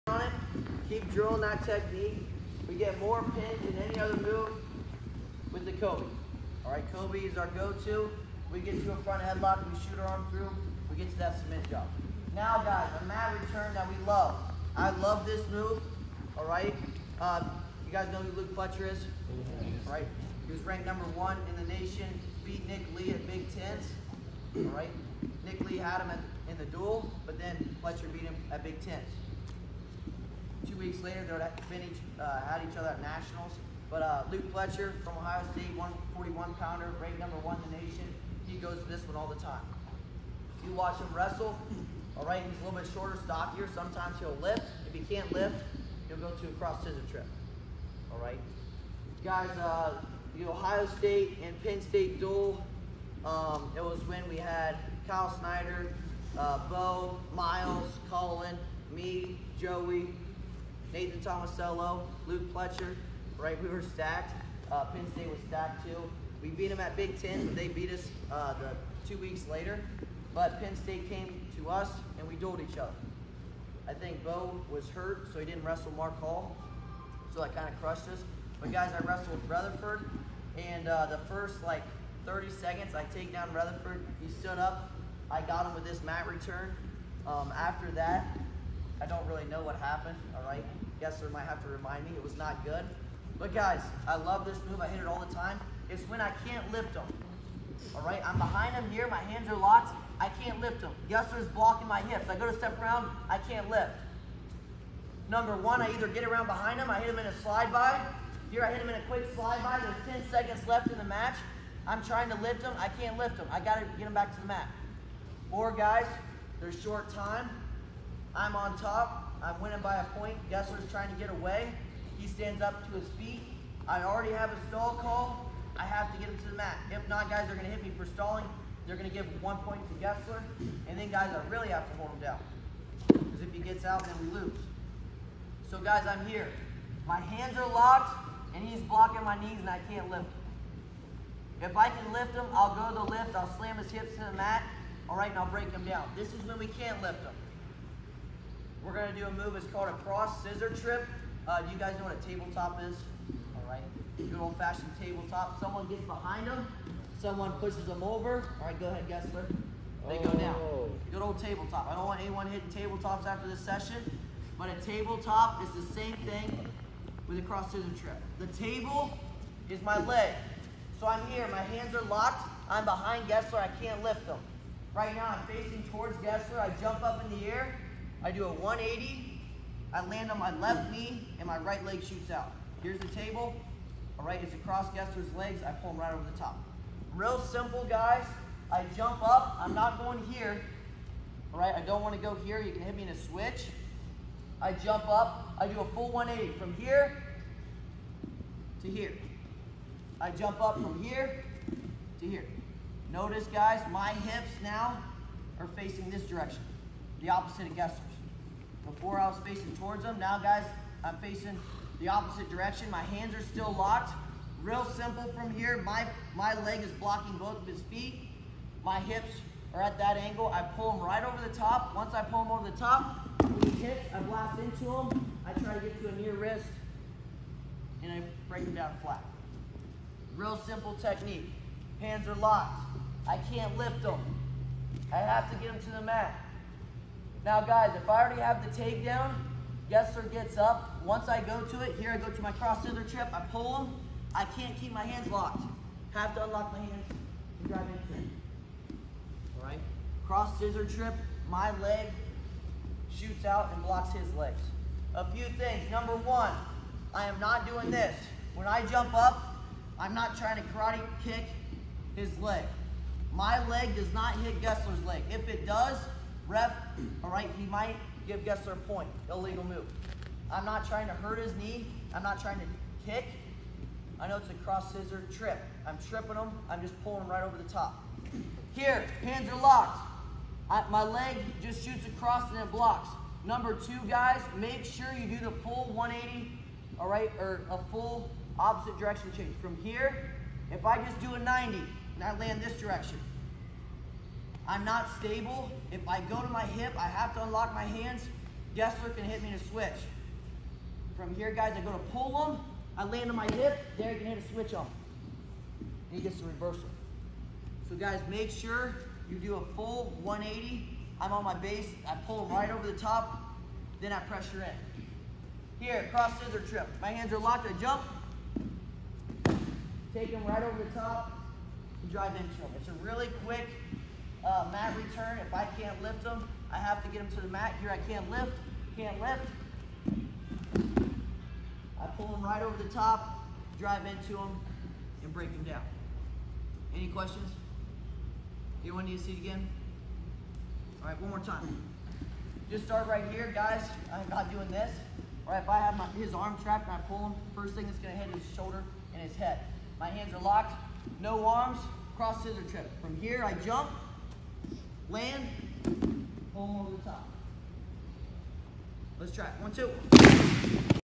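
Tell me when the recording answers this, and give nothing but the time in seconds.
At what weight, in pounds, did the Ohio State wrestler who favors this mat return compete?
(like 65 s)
35 s.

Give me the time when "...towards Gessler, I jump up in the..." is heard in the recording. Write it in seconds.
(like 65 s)
175 s.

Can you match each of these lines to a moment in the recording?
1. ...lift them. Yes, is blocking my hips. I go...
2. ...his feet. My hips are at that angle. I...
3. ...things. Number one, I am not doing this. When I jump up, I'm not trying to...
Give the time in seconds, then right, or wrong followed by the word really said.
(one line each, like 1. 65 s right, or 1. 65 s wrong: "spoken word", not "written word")
1. 100 s right
2. 217 s right
3. 255 s right.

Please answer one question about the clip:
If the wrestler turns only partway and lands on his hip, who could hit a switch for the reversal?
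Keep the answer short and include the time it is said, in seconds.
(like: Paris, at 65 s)
Derek, at 303 s.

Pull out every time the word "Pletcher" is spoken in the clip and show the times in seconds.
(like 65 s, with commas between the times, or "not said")
18 s, 27 s, 34 s, 62 s.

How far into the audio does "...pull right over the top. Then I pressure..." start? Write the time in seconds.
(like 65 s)
312 s.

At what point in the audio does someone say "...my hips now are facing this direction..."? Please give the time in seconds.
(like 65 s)
203 s.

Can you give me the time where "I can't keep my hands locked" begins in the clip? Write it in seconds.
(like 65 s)
244 s.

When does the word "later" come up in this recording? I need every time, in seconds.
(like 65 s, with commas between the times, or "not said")
31 s, 69 s.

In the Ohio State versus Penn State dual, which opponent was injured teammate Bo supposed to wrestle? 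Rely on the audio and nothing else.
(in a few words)
Mark Hall.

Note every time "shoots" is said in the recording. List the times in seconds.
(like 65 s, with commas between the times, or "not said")
9 s, 182 s, 253 s, 281 s.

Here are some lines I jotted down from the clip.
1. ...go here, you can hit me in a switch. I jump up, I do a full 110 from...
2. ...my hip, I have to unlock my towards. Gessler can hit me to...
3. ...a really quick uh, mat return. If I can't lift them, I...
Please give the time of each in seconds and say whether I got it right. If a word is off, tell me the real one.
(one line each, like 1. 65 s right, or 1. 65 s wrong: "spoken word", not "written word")
1. 192 s wrong: "180", not "110"
2. 296 s wrong: "hands", not "towards"
3. 322 s right.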